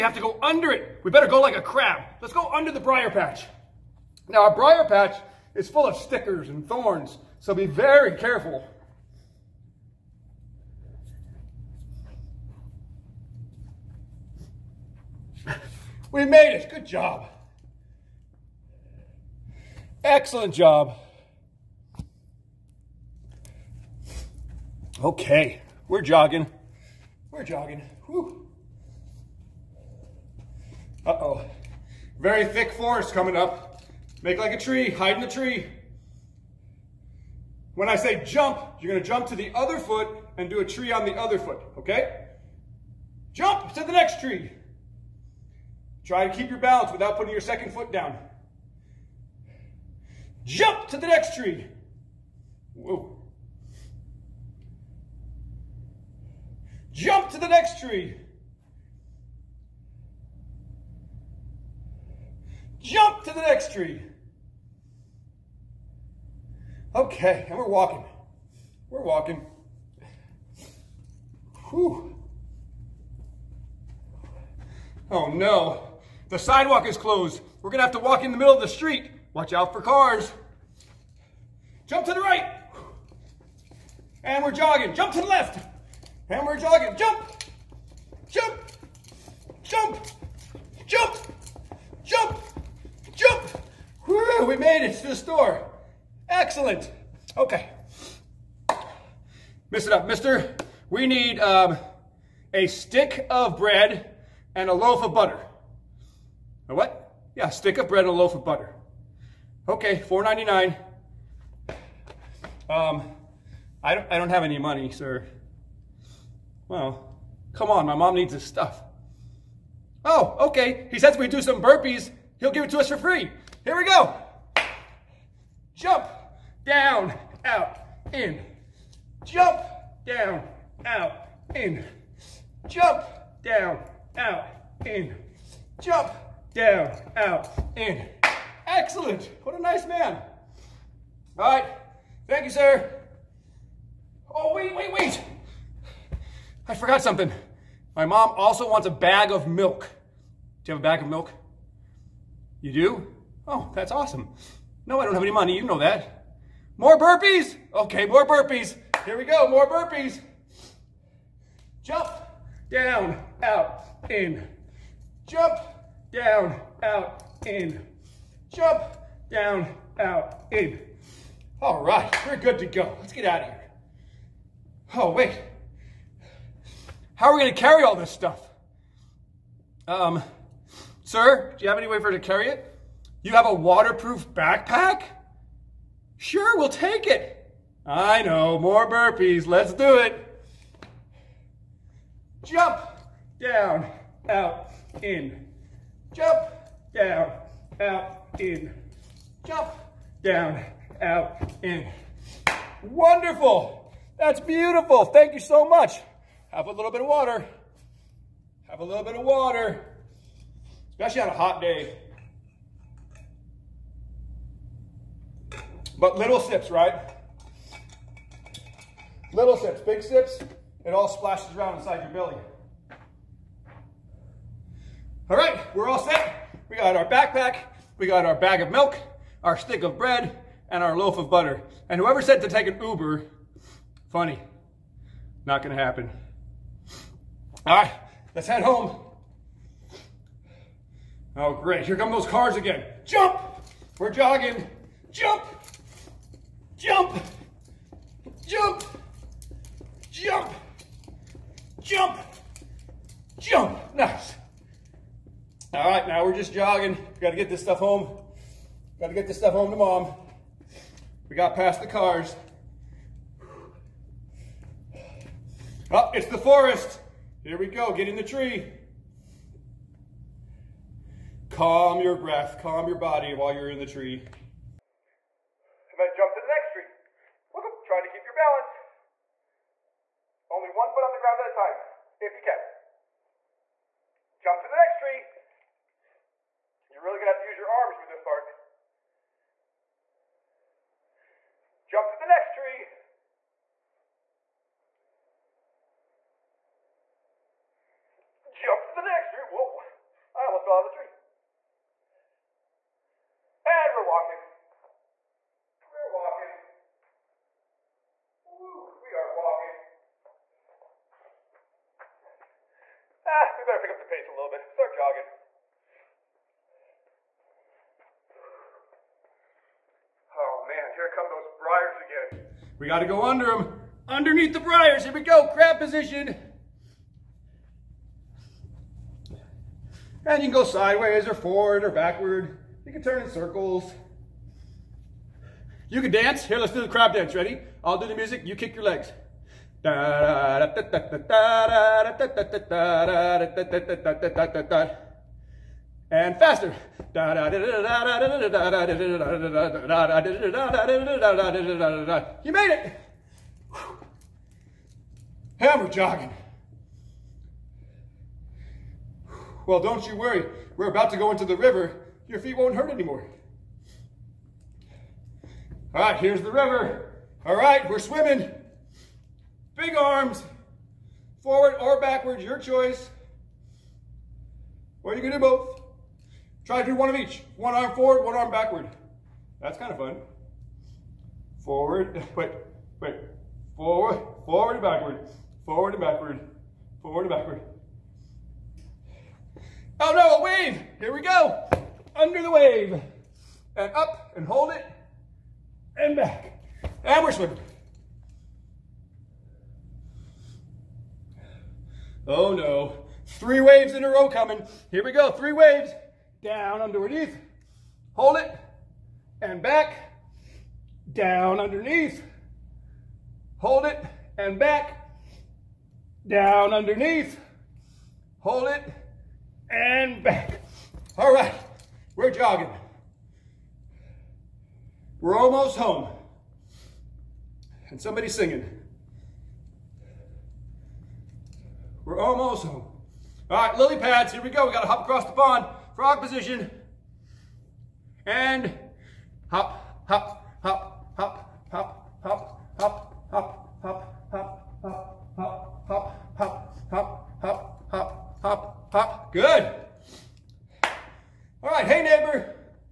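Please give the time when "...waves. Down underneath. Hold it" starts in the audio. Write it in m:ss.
6:45.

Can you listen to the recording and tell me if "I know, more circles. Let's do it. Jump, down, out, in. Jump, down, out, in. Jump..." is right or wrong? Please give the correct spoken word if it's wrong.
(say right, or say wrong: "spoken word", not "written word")
wrong: "burpees", not "circles".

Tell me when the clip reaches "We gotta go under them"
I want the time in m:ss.
5:22.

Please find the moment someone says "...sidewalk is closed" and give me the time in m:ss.
1:16.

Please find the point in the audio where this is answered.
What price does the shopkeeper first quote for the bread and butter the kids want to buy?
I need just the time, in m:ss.
1:50.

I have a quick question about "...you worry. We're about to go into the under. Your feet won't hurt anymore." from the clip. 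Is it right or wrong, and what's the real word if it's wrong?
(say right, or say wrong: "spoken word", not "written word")
wrong: "river", not "under".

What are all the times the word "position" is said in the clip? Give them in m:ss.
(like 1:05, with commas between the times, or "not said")
5:25, 7:16.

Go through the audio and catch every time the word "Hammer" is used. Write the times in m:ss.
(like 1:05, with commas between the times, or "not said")
5:55.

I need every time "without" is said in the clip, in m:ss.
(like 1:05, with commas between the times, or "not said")
0:46.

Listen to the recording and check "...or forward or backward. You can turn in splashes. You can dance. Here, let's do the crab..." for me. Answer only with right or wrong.
wrong.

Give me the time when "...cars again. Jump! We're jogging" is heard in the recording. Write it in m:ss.
4:02.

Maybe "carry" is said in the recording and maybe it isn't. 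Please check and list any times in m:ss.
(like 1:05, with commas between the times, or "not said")
2:57, 3:02.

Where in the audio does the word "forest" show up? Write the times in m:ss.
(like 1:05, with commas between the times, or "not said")
0:32, 4:26.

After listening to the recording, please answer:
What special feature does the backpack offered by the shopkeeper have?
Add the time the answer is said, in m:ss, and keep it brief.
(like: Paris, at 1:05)
waterproof, at 3:03.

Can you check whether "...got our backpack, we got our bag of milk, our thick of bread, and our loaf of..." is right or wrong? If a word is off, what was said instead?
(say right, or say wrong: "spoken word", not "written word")
wrong: "stick", not "thick".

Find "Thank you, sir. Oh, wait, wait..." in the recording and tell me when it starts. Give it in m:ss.
2:22.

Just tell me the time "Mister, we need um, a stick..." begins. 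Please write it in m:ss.
1:40.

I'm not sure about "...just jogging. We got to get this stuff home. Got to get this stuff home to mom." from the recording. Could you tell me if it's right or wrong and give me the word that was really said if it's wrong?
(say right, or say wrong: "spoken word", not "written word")
right.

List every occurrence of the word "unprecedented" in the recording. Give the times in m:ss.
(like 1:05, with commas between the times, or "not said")
not said.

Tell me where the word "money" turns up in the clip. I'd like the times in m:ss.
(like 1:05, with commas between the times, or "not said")
1:54, 2:35.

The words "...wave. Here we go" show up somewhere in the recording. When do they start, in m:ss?
6:30.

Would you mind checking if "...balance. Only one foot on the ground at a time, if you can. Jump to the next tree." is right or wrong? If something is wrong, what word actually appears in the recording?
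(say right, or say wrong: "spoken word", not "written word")
right.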